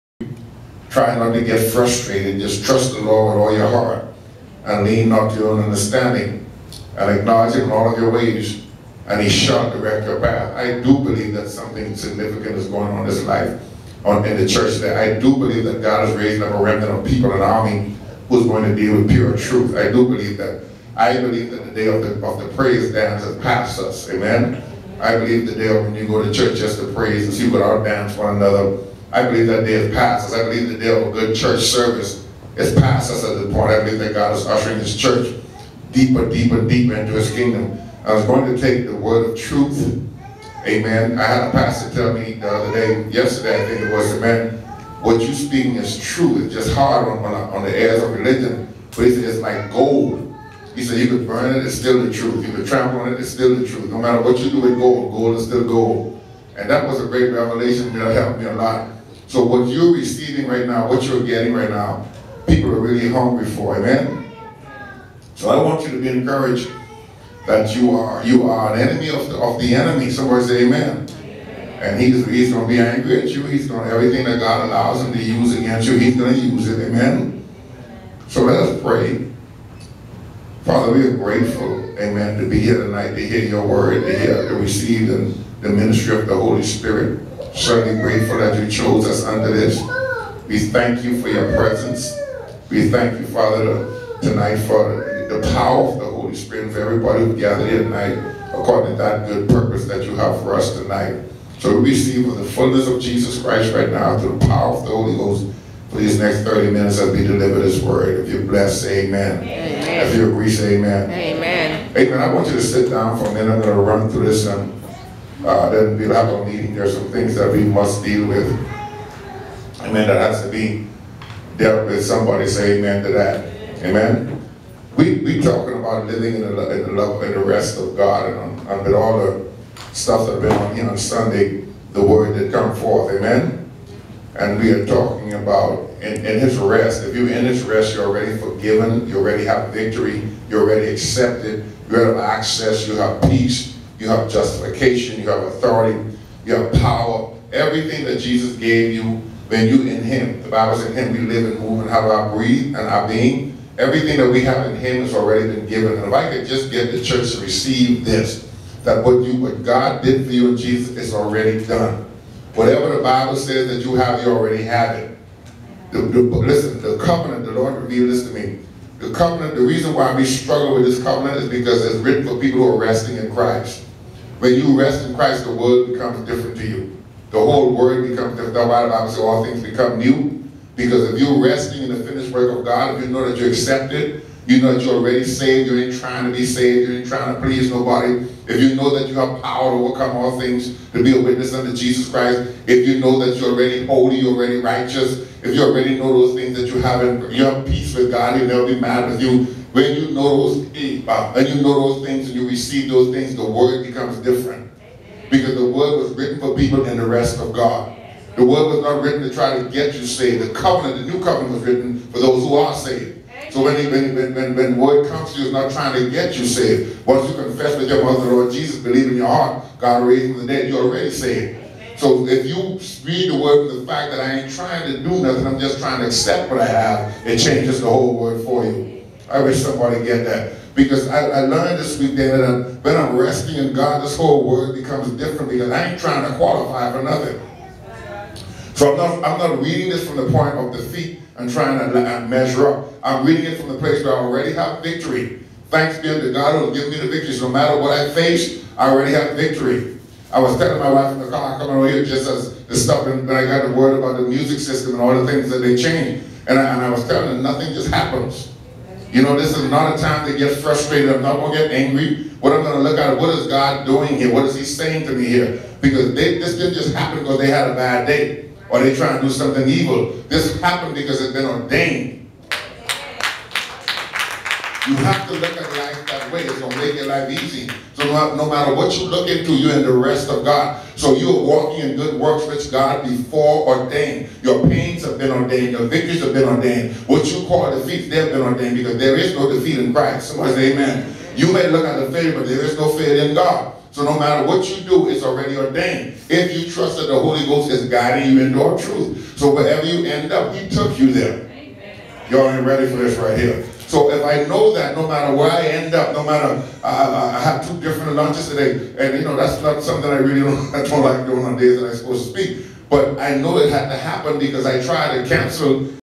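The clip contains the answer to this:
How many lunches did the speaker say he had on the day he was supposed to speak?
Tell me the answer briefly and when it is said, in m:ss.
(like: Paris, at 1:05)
2, at 5:07.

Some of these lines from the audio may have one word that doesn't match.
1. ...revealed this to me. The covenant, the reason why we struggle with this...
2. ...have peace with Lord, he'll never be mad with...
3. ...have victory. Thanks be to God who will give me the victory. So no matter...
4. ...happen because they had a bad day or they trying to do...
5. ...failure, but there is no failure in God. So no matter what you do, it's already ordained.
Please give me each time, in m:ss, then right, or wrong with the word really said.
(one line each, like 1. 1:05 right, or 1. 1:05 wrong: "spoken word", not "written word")
1. 2:47 right
2. 3:17 wrong: "God", not "Lord"
3. 4:04 right
4. 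4:26 right
5. 4:52 right.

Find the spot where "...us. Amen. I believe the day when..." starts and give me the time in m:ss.
0:23.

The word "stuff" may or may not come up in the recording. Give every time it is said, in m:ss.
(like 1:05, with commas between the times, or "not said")
2:09, 4:12.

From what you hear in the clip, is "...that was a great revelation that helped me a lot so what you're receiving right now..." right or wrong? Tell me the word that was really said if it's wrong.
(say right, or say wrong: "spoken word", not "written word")
right.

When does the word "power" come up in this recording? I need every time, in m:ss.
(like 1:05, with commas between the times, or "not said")
1:35, 1:44, 2:26, 3:09.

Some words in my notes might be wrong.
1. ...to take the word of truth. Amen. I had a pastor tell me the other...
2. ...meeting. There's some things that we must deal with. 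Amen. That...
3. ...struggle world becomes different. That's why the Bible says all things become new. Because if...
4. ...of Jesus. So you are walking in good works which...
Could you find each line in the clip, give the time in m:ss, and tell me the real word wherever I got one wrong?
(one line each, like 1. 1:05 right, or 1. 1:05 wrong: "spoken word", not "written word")
1. 0:38 right
2. 1:56 right
3. 2:57 wrong: "whole", not "struggle"
4. 4:40 wrong: "God", not "Jesus".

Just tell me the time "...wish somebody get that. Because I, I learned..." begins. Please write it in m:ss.
3:49.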